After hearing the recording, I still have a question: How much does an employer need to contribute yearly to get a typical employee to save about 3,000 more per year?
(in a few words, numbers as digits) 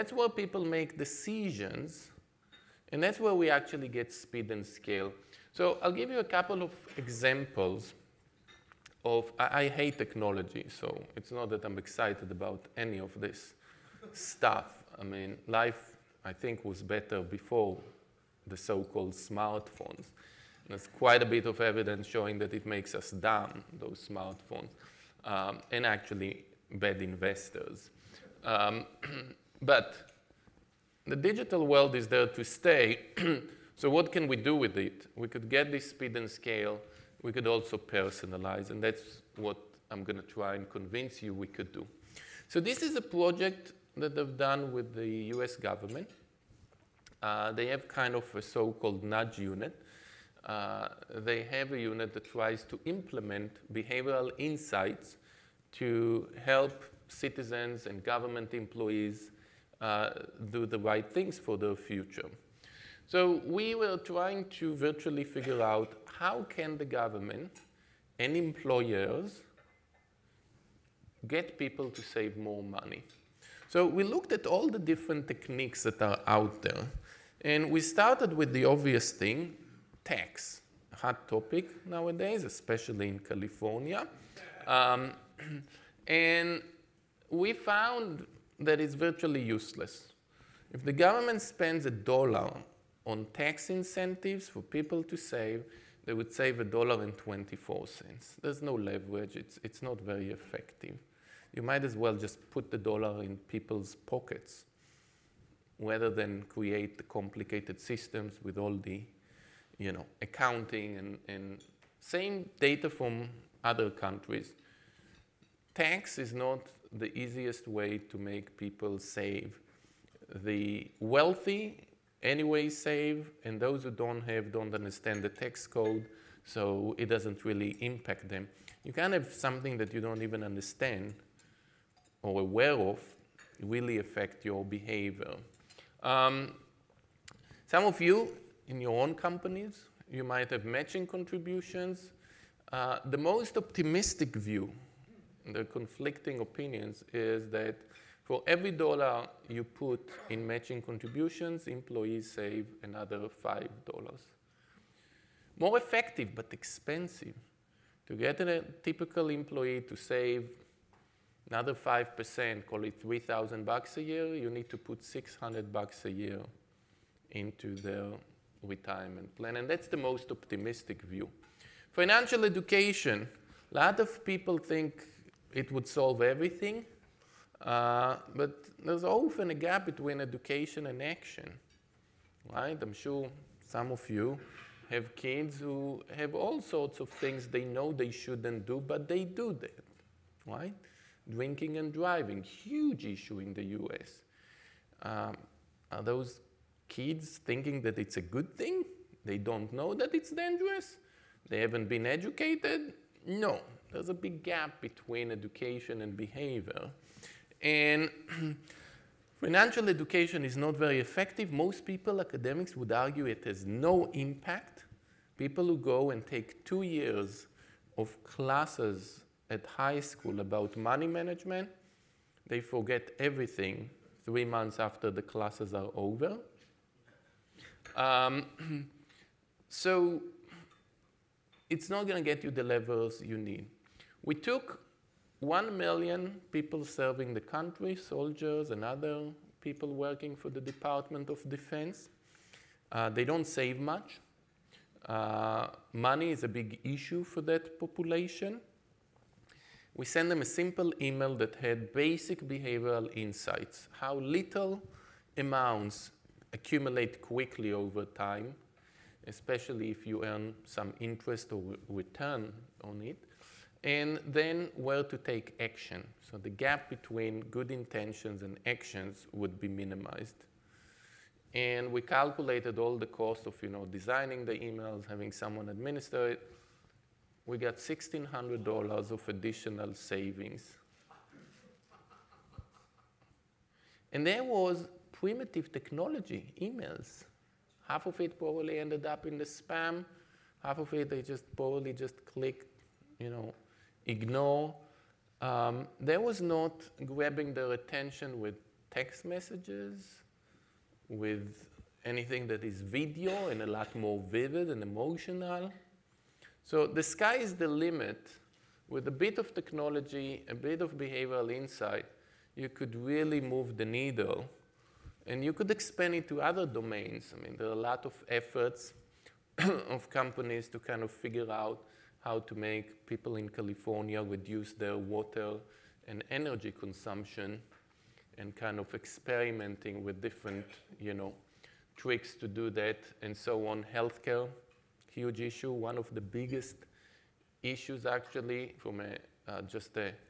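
$600.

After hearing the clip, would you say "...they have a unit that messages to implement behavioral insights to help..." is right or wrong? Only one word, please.
wrong.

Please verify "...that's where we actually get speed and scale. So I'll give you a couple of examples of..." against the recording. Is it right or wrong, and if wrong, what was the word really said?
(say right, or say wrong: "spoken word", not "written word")
right.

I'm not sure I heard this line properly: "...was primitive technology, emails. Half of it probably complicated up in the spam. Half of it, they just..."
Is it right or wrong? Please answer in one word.
wrong.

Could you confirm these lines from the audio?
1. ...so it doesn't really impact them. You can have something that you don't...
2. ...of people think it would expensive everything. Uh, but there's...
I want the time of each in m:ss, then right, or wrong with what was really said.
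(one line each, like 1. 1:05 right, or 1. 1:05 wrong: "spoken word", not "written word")
1. 2:06 right
2. 2:53 wrong: "solve", not "expensive".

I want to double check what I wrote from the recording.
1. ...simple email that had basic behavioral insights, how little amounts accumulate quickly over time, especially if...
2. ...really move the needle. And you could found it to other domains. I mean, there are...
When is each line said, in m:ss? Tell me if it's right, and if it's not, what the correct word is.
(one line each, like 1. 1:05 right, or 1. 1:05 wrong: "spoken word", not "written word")
1. 4:10 right
2. 5:12 wrong: "expand", not "found".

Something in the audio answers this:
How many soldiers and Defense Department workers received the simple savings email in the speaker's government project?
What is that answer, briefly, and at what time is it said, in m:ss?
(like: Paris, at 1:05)
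1 million, at 3:55.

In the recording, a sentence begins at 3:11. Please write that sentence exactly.
Drinking and driving, huge issue in the US.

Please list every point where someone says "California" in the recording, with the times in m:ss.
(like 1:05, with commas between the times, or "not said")
1:23, 5:23.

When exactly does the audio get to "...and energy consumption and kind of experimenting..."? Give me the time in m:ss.
5:26.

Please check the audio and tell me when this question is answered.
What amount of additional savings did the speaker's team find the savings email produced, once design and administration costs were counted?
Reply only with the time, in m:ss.
4:37.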